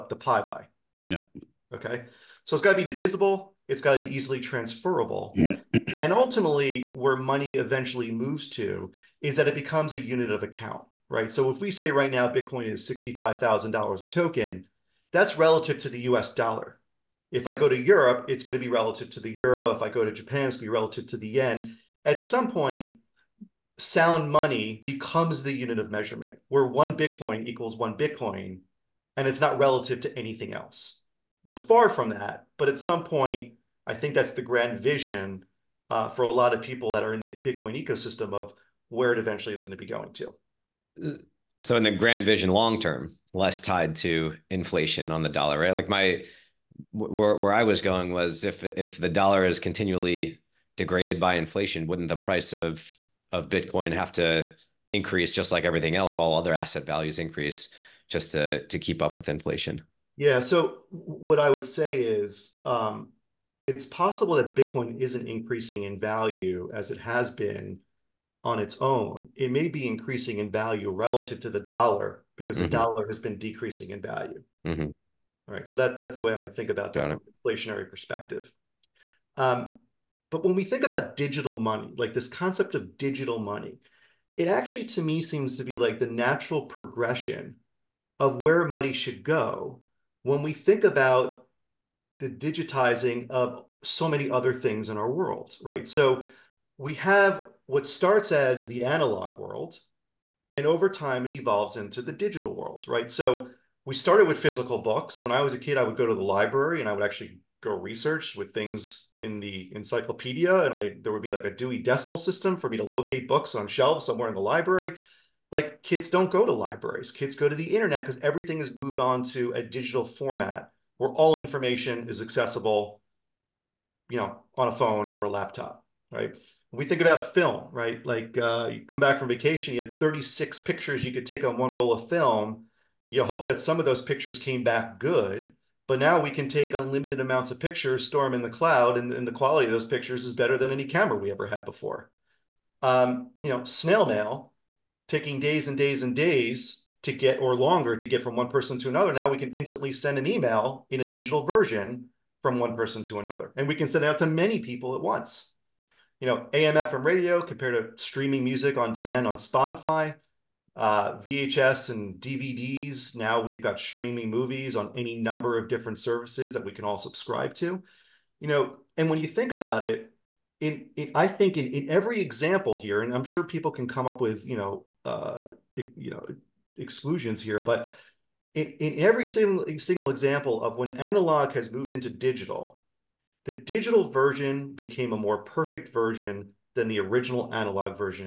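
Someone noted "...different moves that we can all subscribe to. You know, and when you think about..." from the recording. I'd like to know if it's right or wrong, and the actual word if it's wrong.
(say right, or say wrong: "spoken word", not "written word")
wrong: "services", not "moves".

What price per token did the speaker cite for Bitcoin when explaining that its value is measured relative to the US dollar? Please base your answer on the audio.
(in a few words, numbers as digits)
$65,000.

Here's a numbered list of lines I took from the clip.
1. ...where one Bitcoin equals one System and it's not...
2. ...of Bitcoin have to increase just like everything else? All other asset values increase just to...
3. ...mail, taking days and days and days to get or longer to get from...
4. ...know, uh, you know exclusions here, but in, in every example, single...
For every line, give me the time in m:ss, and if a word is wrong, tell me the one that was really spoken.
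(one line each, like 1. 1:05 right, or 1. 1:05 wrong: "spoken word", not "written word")
1. 0:26 wrong: "Bitcoin", not "System"
2. 0:53 right
3. 2:24 right
4. 2:54 wrong: "single", not "example".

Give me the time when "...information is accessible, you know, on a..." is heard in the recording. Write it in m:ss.
2:01.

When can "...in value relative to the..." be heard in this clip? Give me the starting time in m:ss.
1:10.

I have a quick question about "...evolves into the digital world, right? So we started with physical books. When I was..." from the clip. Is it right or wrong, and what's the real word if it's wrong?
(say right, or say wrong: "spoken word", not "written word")
right.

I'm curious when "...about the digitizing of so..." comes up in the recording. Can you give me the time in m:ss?
1:30.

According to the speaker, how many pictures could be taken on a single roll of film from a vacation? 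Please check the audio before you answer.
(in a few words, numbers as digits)
36.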